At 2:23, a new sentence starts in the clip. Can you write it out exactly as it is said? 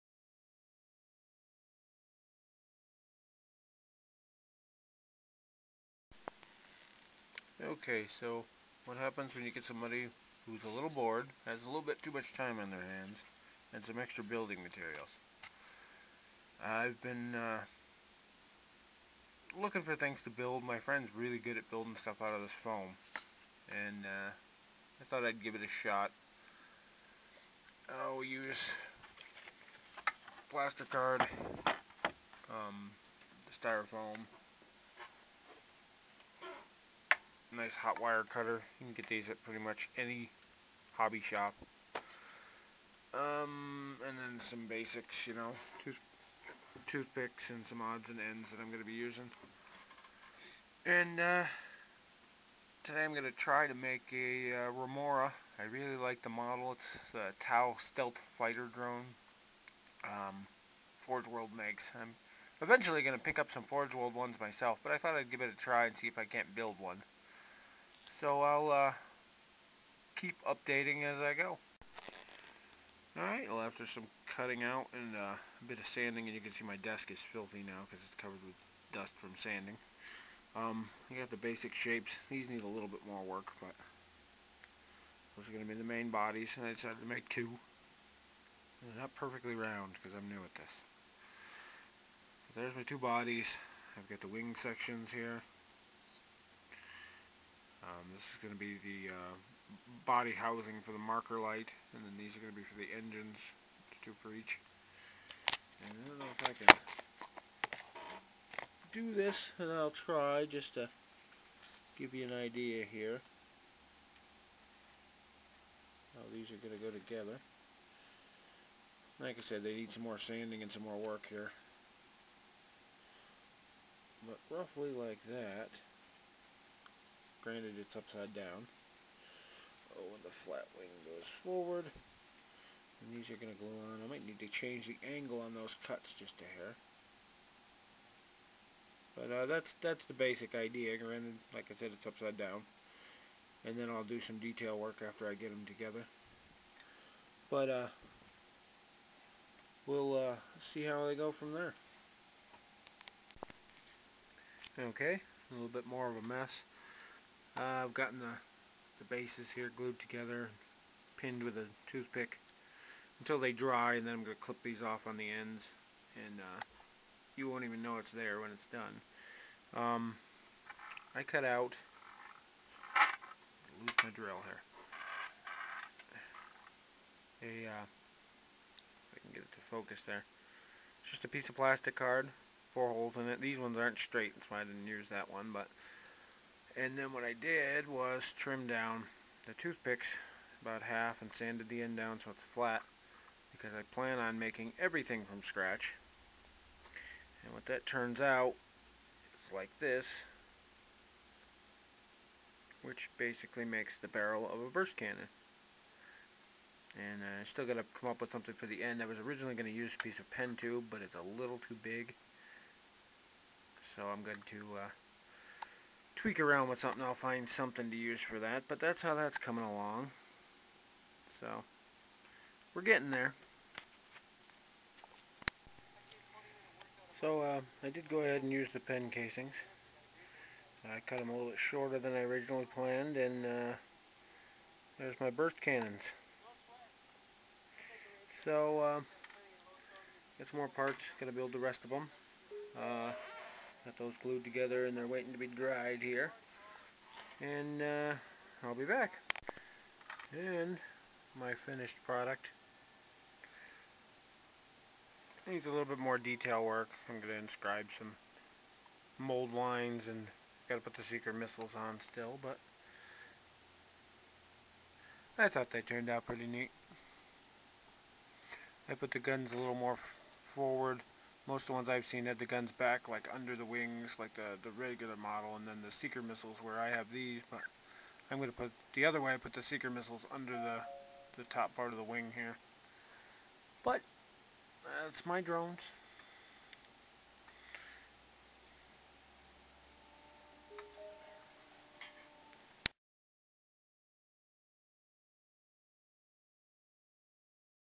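And then I'll do some detail work after I get them together.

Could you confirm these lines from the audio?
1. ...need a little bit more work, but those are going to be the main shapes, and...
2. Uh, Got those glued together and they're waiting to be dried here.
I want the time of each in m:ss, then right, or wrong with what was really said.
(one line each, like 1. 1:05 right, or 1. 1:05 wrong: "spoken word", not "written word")
1. 1:22 wrong: "bodies", not "shapes"
2. 4:02 right.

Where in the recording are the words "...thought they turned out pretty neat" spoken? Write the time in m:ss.
4:25.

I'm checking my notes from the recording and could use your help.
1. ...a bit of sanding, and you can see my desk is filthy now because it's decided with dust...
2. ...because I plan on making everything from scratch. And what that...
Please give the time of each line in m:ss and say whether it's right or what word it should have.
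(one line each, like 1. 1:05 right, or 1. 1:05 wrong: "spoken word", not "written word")
1. 1:15 wrong: "covered", not "decided"
2. 3:13 right.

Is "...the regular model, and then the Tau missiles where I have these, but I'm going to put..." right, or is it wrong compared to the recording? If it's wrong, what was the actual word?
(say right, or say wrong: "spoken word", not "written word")
wrong: "Seeker", not "Tau".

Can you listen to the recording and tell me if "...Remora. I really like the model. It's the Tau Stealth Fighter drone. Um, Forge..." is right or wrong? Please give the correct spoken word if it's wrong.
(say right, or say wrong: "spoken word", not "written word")
right.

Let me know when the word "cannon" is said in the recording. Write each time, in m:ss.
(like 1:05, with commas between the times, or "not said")
3:24, 3:55.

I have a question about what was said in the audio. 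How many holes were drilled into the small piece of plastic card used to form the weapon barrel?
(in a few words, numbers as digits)
4.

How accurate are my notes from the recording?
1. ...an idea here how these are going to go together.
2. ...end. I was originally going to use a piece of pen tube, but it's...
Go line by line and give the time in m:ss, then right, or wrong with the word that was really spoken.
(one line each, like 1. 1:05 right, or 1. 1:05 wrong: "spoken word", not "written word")
1. 1:52 right
2. 3:28 right.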